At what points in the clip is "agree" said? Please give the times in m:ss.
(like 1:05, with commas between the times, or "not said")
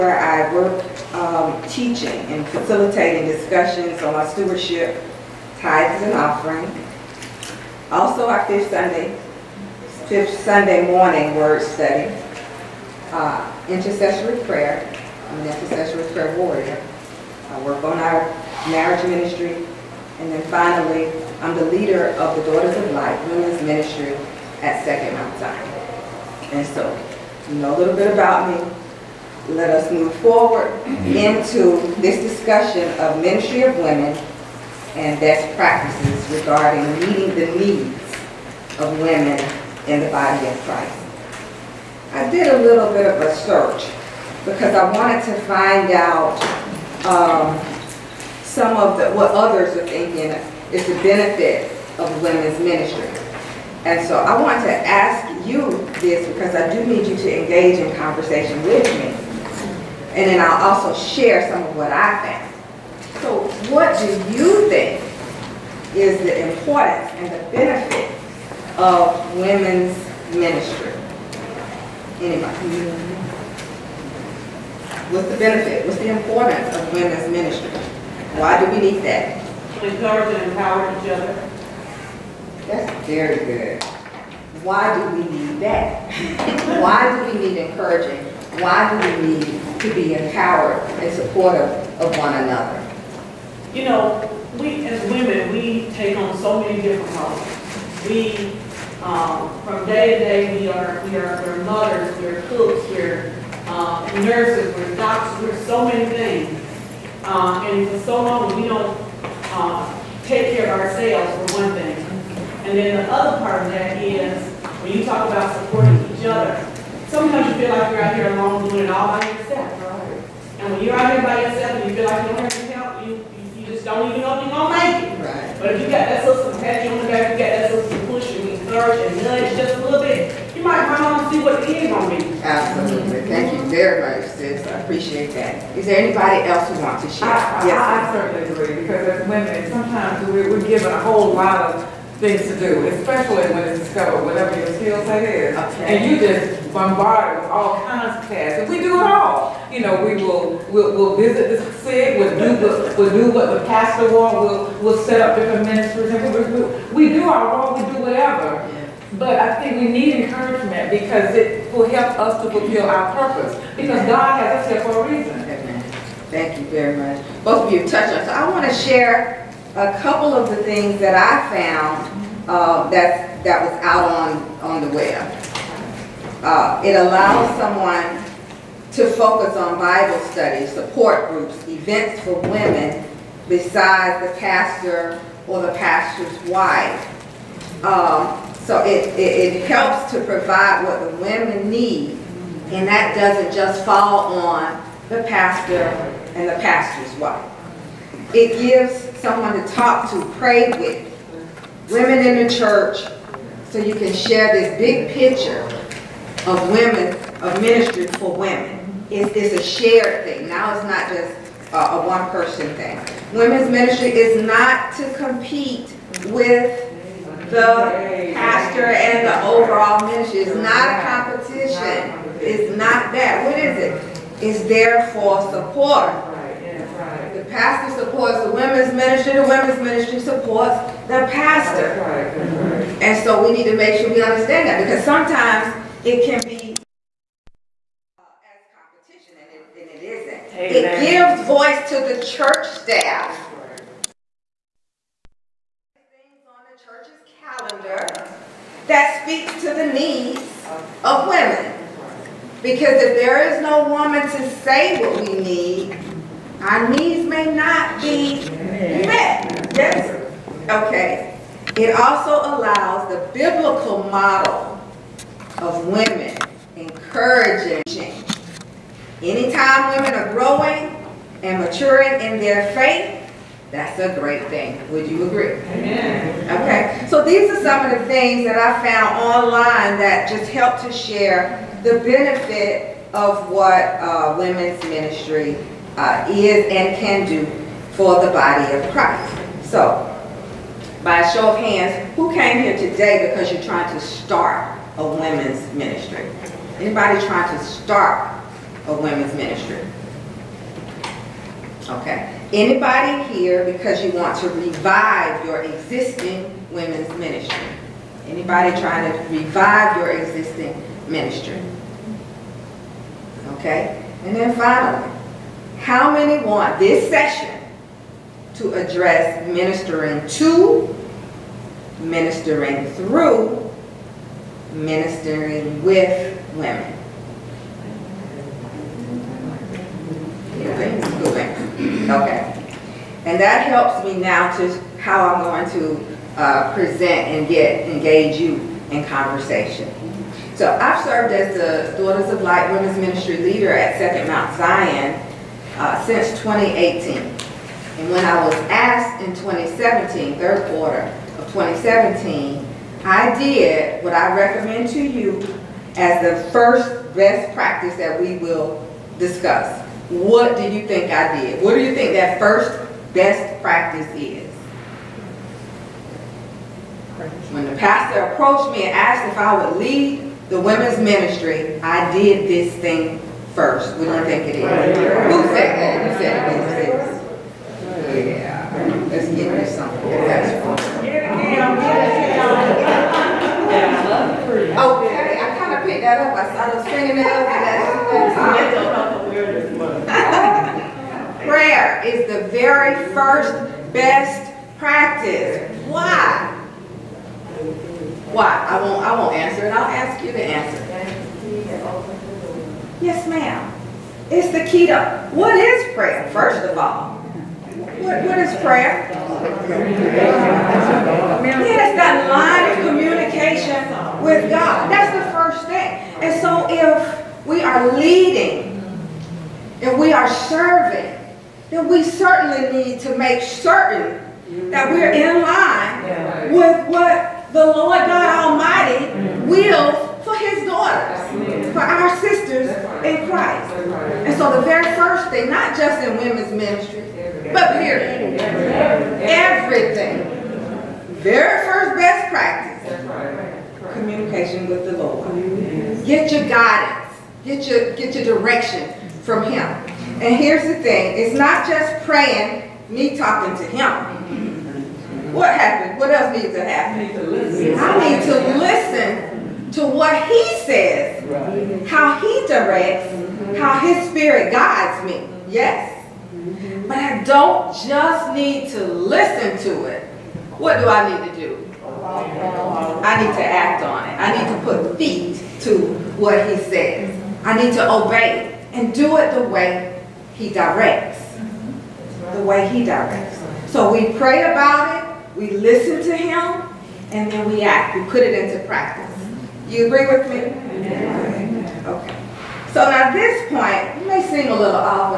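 2:18, 4:35, 8:09.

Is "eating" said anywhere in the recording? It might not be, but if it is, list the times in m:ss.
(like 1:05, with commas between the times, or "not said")
not said.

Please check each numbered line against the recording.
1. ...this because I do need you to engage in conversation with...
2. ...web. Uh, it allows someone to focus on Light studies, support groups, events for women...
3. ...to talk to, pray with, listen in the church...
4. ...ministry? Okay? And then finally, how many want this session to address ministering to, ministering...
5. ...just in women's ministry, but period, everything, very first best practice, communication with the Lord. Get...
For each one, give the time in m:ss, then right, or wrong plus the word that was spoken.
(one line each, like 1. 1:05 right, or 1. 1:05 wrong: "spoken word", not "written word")
1. 0:56 right
2. 2:54 wrong: "Bible", not "Light"
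3. 3:19 wrong: "women", not "listen"
4. 5:11 right
5. 7:15 right.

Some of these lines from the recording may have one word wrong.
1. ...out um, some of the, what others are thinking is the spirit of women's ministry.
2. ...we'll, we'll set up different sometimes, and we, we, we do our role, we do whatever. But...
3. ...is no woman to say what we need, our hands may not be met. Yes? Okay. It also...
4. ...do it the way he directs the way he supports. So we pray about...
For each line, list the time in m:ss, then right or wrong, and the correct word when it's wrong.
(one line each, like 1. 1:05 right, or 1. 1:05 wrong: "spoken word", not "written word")
1. 0:45 wrong: "benefit", not "spirit"
2. 2:34 wrong: "ministries", not "sometimes"
3. 4:13 wrong: "needs", not "hands"
4. 7:58 wrong: "directs", not "supports".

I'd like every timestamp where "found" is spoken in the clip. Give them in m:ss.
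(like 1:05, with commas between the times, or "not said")
2:51, 4:38.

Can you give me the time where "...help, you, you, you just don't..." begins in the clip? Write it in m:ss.
2:02.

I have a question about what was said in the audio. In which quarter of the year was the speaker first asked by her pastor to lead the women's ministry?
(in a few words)
third quarter.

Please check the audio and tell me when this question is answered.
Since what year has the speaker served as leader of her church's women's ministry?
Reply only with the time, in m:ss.
5:46.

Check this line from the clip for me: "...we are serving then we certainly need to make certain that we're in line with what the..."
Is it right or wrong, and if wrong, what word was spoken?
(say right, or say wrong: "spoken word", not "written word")
right.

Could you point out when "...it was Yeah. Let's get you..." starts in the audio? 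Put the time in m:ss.
6:16.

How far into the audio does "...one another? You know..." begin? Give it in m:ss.
1:32.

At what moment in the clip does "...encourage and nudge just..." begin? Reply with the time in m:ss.
2:08.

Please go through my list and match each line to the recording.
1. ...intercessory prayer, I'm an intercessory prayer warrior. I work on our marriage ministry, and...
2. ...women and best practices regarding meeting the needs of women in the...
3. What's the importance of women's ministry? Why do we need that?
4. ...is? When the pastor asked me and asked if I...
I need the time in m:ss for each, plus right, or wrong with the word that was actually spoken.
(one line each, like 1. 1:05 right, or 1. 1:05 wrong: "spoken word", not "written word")
1. 0:13 right
2. 0:33 right
3. 1:15 right
4. 6:04 wrong: "approached", not "asked".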